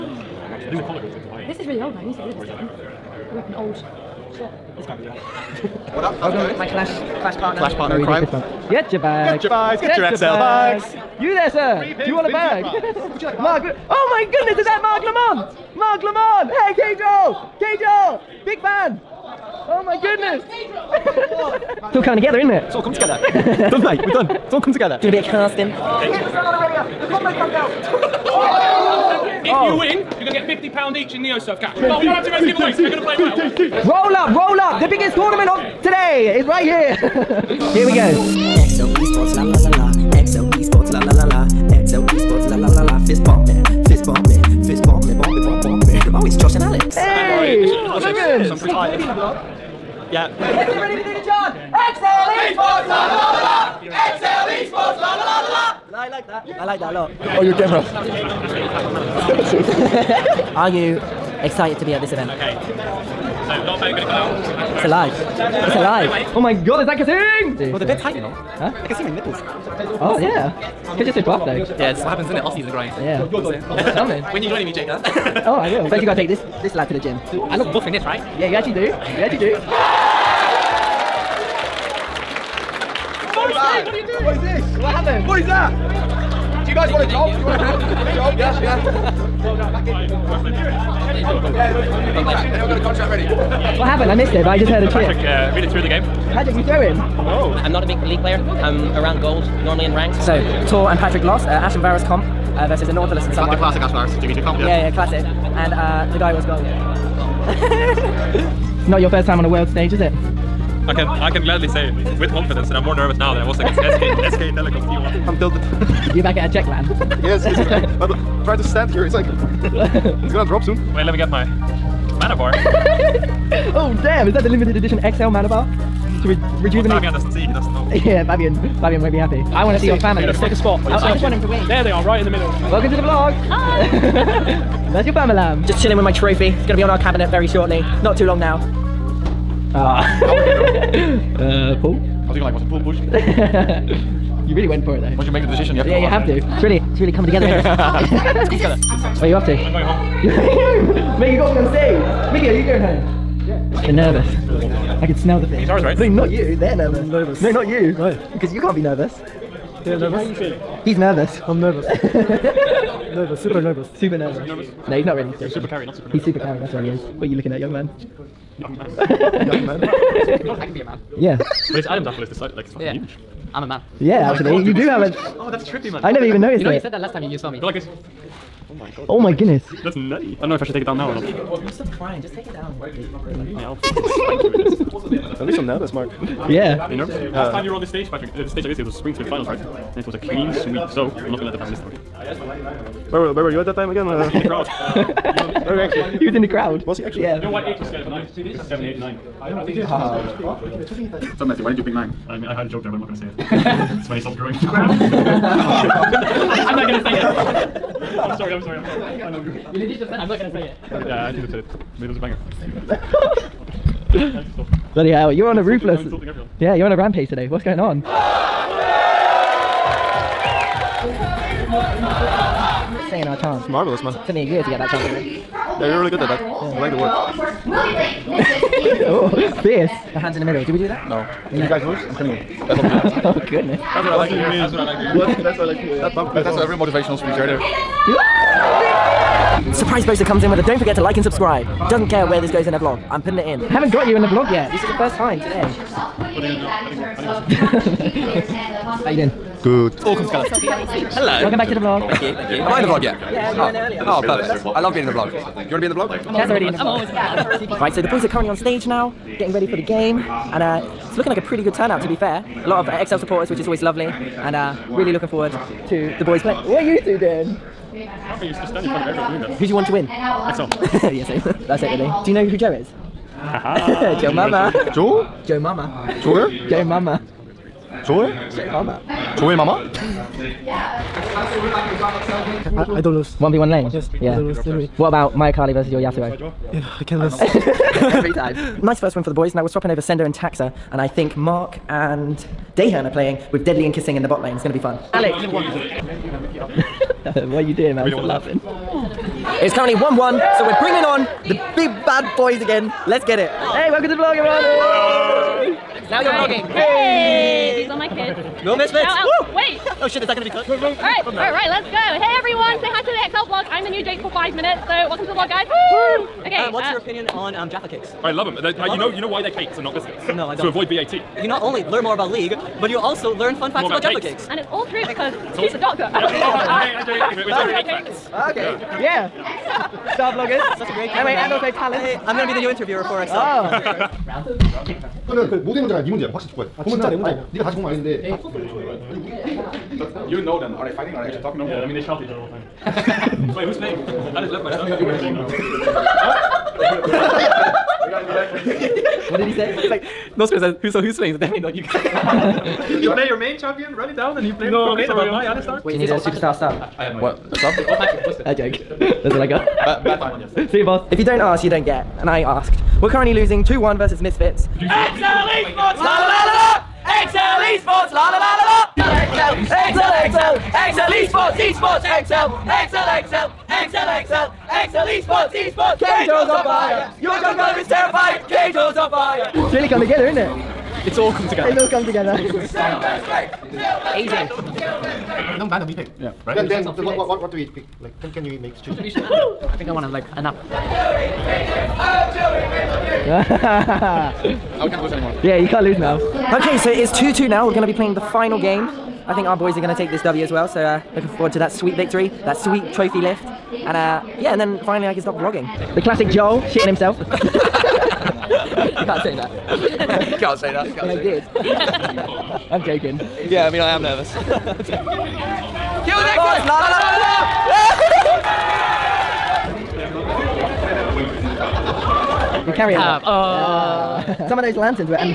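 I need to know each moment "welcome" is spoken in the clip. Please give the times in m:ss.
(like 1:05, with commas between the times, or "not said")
2:12, 4:11, 5:03, 5:14.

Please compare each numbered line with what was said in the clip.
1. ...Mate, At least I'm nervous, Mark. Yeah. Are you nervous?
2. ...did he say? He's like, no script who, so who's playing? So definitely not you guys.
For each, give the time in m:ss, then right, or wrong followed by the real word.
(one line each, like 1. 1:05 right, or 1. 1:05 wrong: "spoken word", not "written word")
1. 3:05 right
2. 5:49 right.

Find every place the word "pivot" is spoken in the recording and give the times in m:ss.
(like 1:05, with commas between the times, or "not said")
not said.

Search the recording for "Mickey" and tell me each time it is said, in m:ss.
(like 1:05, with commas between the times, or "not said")
2:32, 2:39.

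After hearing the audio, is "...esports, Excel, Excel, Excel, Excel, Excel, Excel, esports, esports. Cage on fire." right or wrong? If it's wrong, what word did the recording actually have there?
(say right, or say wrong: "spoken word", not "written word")
right.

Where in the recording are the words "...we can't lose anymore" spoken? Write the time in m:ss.
6:34.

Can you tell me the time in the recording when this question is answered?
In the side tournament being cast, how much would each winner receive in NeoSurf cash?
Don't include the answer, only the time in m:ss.
0:30.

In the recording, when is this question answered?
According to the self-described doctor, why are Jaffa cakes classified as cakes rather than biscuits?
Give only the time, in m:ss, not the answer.
5:20.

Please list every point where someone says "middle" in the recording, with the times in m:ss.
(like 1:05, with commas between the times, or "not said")
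2:12, 3:50.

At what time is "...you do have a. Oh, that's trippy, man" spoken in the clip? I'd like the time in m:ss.
2:54.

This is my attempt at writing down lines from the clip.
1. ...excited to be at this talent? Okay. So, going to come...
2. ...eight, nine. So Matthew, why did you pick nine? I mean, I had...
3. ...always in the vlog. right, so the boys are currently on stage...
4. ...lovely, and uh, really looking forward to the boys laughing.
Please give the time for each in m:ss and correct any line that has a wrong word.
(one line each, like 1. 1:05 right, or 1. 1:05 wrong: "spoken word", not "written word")
1. 1:01 wrong: "event", not "talent"
2. 3:18 right
3. 4:16 right
4. 4:23 wrong: "playing", not "laughing".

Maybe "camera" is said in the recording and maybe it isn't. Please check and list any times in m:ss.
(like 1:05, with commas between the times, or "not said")
0:57, 5:31.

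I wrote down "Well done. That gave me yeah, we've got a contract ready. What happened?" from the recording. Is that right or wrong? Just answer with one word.
right.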